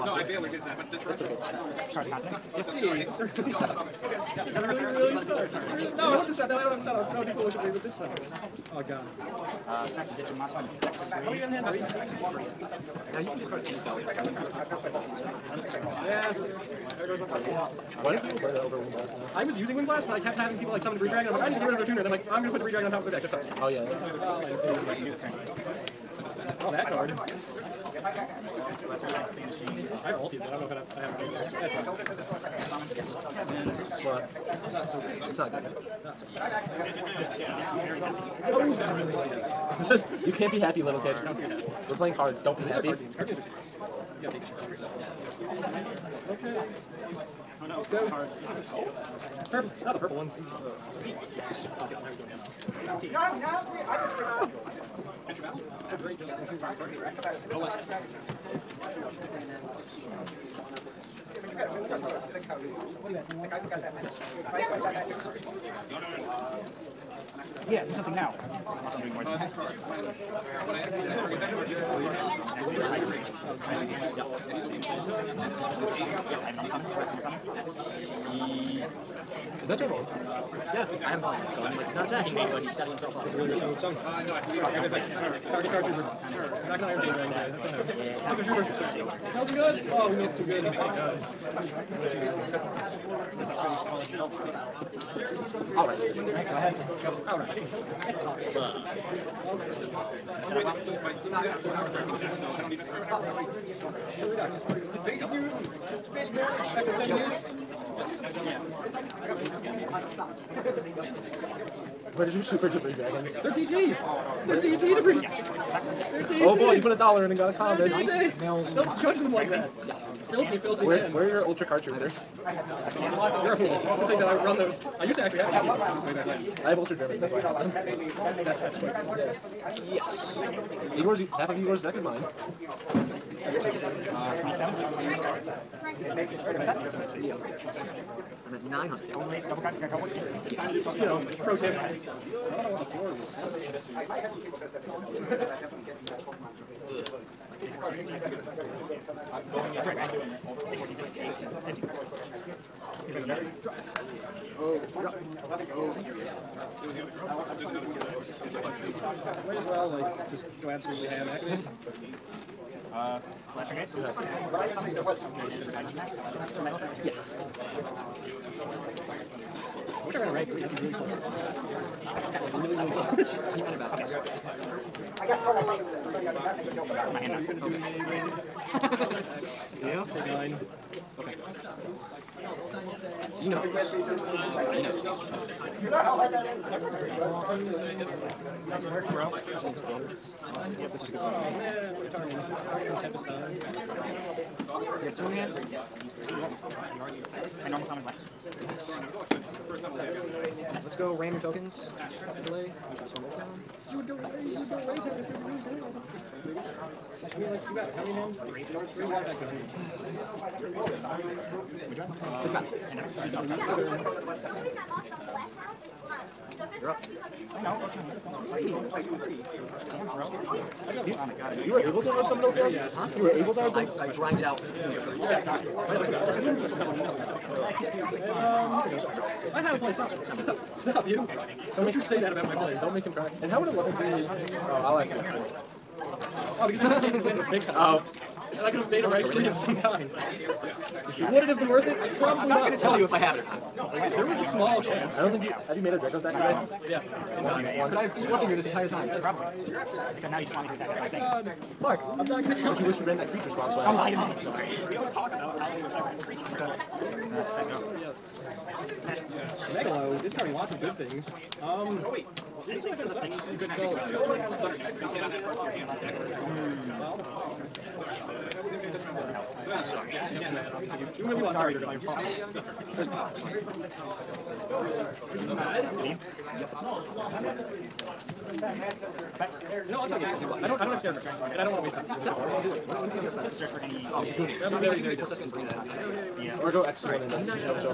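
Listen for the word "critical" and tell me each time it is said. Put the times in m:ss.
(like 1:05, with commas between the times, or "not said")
not said.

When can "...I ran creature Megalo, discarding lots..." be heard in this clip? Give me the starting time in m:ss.
4:15.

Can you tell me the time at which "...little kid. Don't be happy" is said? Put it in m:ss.
0:40.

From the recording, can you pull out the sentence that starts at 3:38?
Don't You, were able to run some of those down?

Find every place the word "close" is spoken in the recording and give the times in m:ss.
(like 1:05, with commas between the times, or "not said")
2:52.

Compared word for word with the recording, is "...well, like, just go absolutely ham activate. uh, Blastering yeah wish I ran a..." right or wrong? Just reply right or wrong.
right.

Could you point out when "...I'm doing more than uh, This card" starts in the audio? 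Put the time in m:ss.
1:08.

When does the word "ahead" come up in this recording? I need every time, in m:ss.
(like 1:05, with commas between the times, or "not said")
1:36.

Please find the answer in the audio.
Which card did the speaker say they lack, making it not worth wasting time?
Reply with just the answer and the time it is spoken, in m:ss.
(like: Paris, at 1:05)
Scarecrow, at 4:40.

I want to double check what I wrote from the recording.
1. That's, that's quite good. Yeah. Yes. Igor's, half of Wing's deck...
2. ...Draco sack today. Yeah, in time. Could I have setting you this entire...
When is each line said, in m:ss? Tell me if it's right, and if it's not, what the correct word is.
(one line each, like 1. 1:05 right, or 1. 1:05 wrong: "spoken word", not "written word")
1. 2:08 wrong: "Igor", not "Wing"
2. 4:05 wrong: "bluffing", not "setting".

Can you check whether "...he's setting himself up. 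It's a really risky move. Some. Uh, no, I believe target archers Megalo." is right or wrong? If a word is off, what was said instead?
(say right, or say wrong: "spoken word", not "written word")
wrong: "Sure", not "Megalo".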